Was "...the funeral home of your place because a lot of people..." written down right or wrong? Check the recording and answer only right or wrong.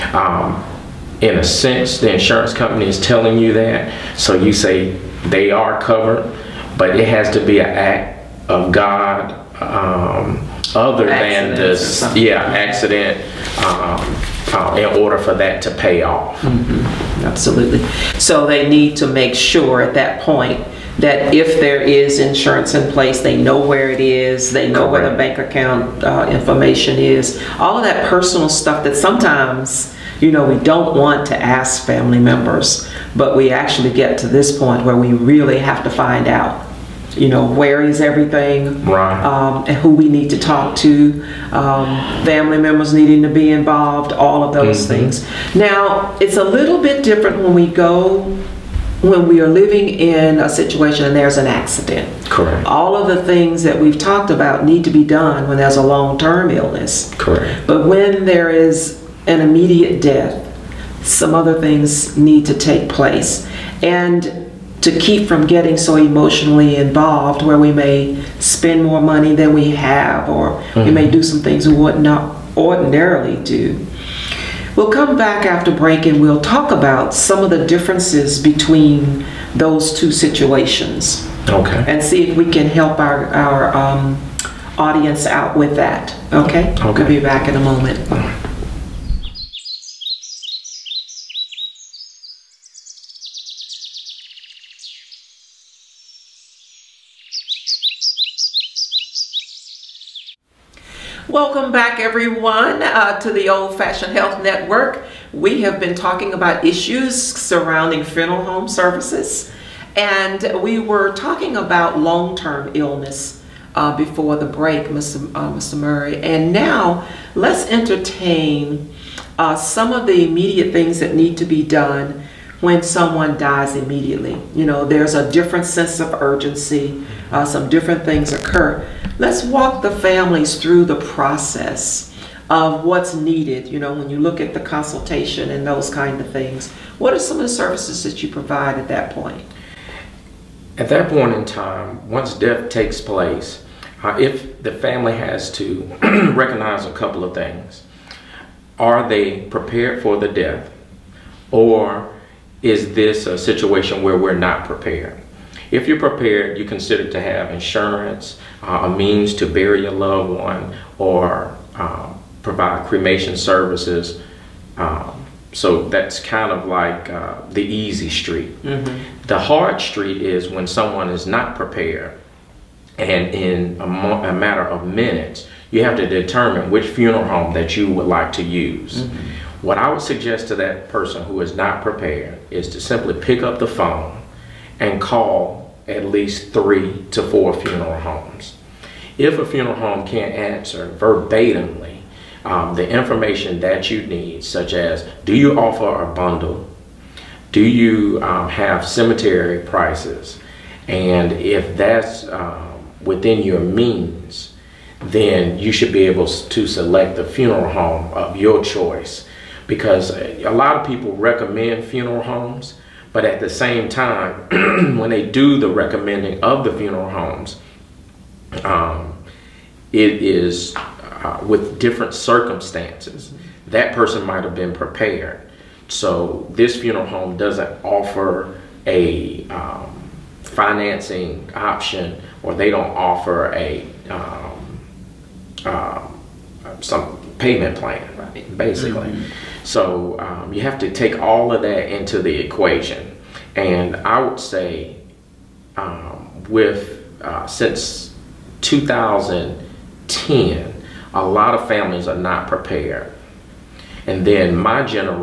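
wrong.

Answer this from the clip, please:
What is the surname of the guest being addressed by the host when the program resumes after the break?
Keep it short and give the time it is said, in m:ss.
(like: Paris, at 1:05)
Murray, at 1:55.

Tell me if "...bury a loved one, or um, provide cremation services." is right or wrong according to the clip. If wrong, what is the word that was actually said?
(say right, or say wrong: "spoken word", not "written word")
right.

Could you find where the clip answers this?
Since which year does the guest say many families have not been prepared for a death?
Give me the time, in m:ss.
4:08.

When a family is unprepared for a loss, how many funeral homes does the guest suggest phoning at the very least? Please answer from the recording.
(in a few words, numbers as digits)
3 to 4.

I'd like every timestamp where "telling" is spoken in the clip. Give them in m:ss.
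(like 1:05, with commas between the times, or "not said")
0:02.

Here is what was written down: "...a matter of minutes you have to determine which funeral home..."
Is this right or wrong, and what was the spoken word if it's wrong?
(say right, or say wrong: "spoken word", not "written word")
right.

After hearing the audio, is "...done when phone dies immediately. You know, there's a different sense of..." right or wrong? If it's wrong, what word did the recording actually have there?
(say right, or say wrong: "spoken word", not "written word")
wrong: "someone", not "phone".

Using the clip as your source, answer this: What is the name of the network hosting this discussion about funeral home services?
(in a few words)
Old Fashioned Health Network.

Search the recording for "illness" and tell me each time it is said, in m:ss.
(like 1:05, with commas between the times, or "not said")
0:56, 1:52.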